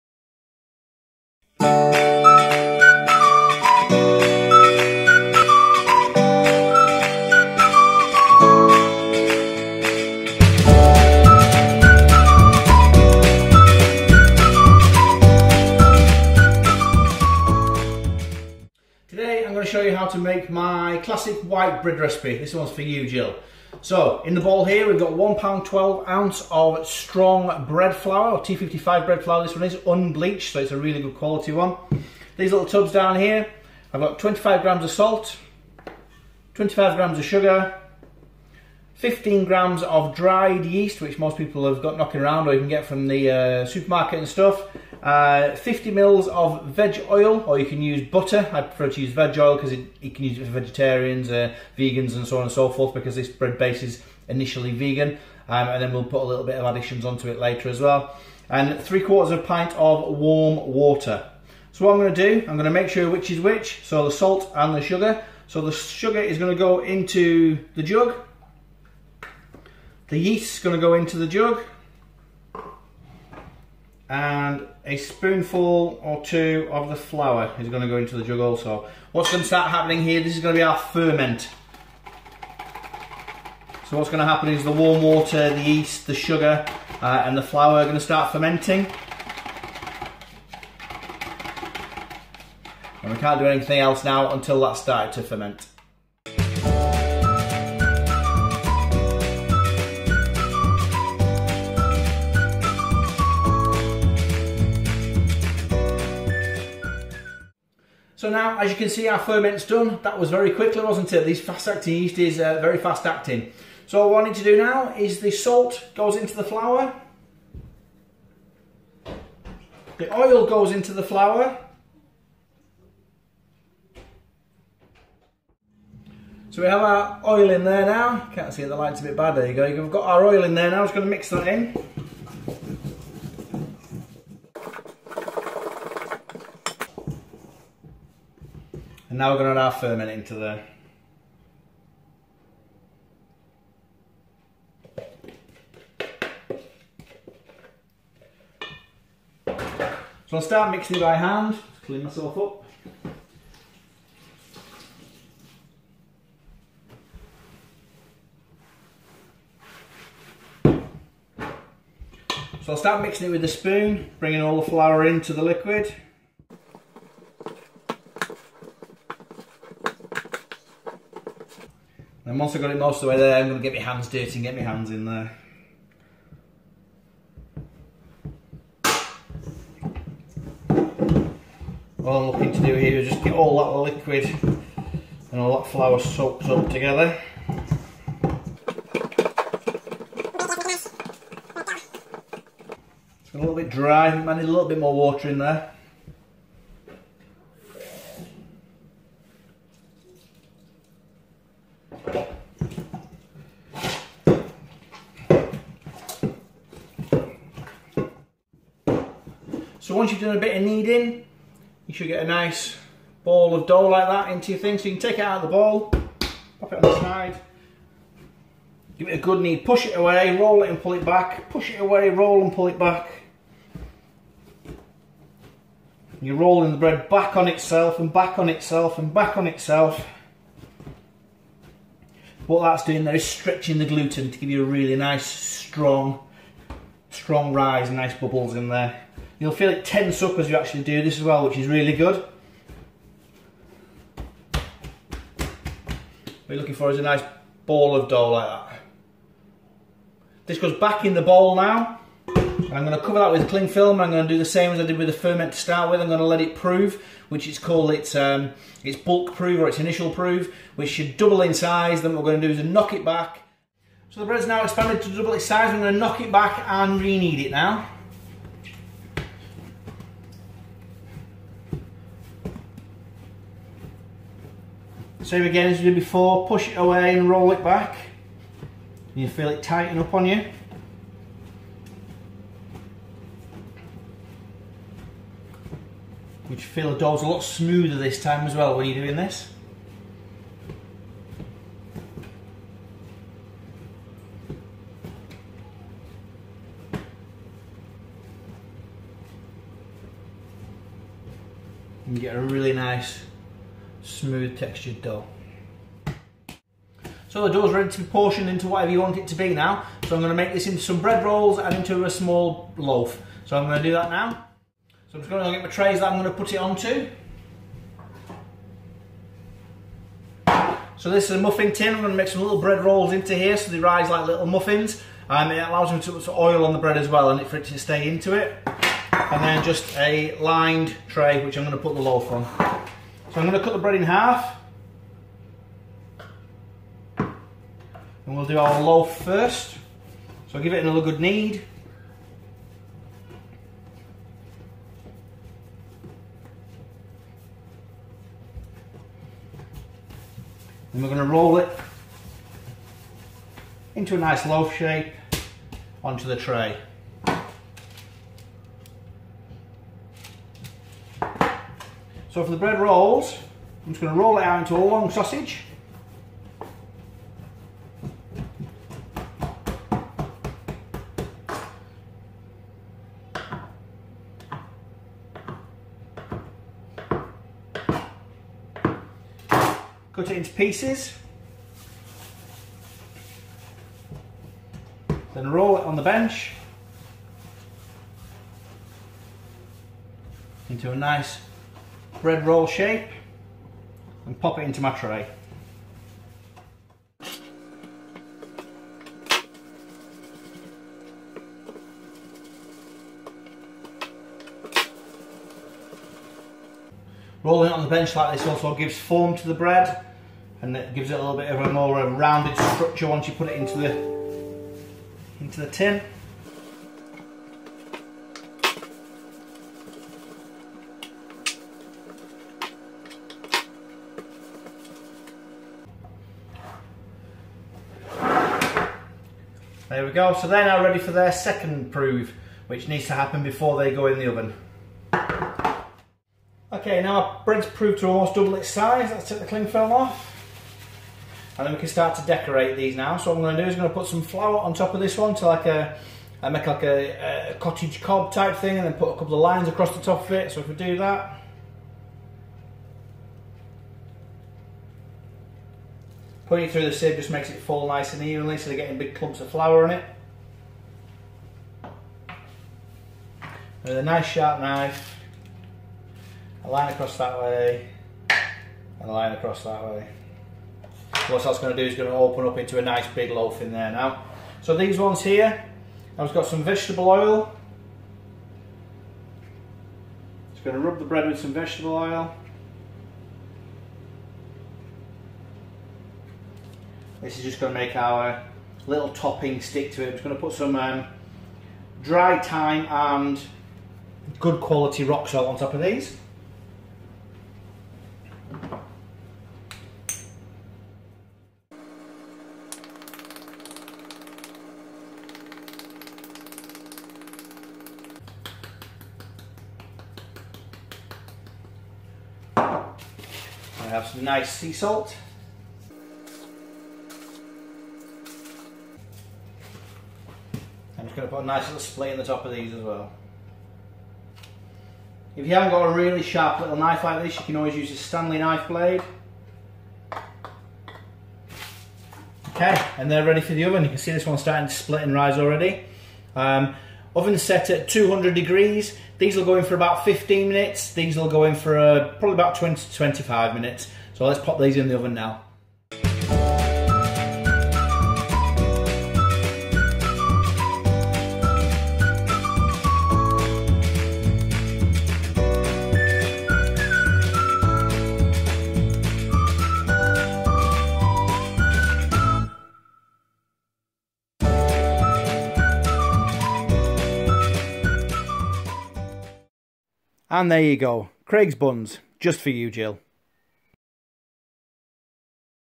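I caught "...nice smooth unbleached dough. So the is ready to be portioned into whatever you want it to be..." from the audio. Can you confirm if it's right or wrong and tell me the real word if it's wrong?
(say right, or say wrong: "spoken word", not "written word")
wrong: "textured", not "unbleached".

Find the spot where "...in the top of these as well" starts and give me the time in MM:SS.
08:42.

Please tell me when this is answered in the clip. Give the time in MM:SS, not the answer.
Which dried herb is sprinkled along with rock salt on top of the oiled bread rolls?
08:12.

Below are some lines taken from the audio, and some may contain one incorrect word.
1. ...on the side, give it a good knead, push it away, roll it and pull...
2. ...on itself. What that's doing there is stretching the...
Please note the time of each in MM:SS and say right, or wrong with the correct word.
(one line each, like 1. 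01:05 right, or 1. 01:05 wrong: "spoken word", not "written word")
1. 03:36 right
2. 03:49 right.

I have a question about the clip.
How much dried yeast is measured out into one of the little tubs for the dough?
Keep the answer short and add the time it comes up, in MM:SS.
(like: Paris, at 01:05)
15 grams, at 00:38.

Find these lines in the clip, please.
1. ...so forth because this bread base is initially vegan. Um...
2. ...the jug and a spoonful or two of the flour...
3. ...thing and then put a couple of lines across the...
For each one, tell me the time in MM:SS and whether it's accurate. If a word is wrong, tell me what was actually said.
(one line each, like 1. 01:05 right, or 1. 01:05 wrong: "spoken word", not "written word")
1. 00:52 right
2. 01:11 right
3. 07:28 right.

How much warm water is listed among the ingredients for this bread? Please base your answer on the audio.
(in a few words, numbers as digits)
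3/4 pint.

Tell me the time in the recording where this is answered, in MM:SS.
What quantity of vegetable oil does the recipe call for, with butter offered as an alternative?
00:45.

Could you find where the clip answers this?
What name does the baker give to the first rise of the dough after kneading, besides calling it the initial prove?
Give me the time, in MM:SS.
04:18.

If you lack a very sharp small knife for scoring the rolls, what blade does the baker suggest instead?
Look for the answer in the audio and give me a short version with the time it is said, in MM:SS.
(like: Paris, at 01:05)
Stanley knife blade, at 08:47.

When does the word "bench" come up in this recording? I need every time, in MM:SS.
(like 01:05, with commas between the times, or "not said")
06:26, 06:47.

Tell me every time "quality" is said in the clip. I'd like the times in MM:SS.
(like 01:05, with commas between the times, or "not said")
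00:31, 08:14.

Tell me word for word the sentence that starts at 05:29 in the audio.
And then just a lined tray which I'm going to put the loaf on.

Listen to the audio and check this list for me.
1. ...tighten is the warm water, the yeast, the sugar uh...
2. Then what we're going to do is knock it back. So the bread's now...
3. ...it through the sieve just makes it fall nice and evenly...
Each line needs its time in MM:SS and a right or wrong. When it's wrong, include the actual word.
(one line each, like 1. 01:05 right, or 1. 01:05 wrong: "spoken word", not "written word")
1. 01:24 wrong: "happen", not "tighten"
2. 04:22 right
3. 07:36 right.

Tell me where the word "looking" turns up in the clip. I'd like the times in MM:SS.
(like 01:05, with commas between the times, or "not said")
03:02, 04:06.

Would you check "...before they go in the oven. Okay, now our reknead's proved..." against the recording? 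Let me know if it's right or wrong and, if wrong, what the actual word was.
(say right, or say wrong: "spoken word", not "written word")
wrong: "bread", not "reknead".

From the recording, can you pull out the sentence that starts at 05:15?
So I'm just going to get my trays that I'm going to put it onto.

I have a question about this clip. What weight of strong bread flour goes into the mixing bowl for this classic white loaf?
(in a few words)
1 pound 12 ounces.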